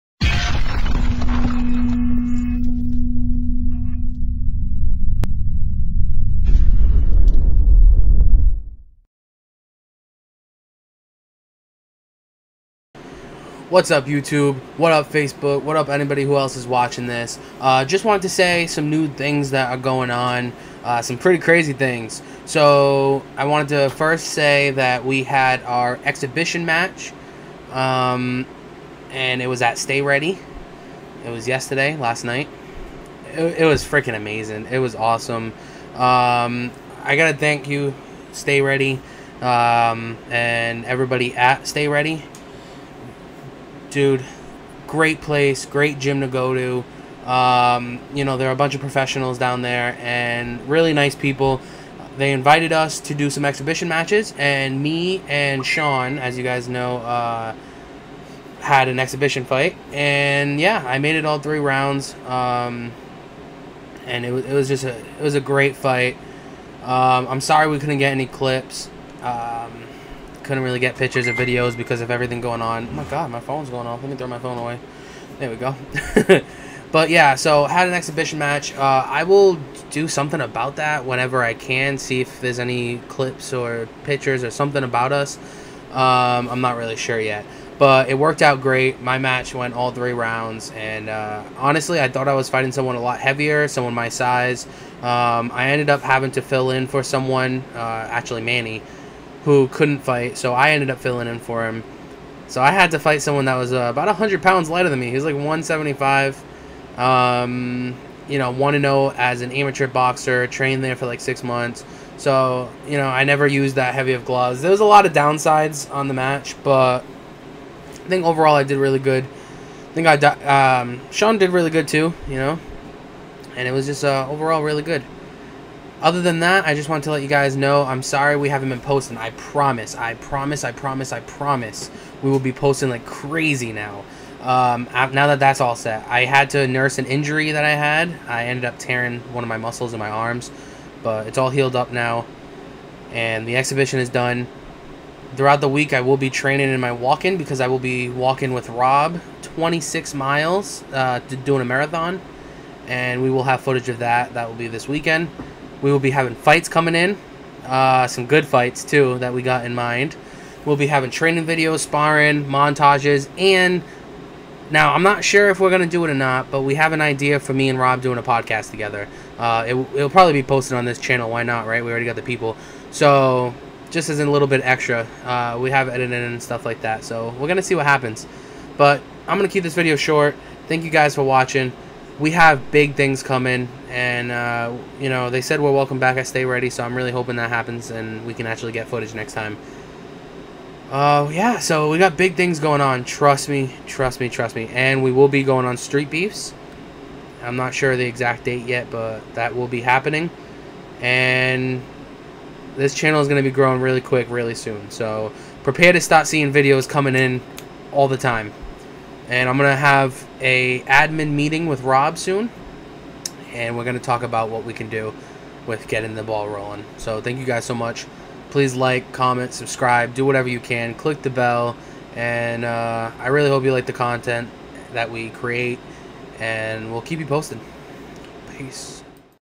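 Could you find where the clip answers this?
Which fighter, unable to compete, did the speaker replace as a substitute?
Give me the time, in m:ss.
1:38.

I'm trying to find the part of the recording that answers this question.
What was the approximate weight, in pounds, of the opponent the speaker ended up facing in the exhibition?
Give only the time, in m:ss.
1:45.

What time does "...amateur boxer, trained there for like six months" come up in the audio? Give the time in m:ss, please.
1:49.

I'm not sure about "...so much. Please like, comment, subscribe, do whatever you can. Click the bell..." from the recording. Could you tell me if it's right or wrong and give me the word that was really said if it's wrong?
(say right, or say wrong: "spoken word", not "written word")
right.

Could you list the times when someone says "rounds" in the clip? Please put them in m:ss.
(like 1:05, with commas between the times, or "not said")
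1:01, 1:30.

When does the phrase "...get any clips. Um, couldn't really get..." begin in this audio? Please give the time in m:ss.
1:07.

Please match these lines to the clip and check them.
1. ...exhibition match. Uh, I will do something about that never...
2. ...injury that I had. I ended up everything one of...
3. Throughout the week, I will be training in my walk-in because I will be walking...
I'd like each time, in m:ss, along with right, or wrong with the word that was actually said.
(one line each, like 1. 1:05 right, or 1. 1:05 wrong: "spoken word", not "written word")
1. 1:17 wrong: "whenever", not "never"
2. 2:17 wrong: "tearing", not "everything"
3. 2:25 right.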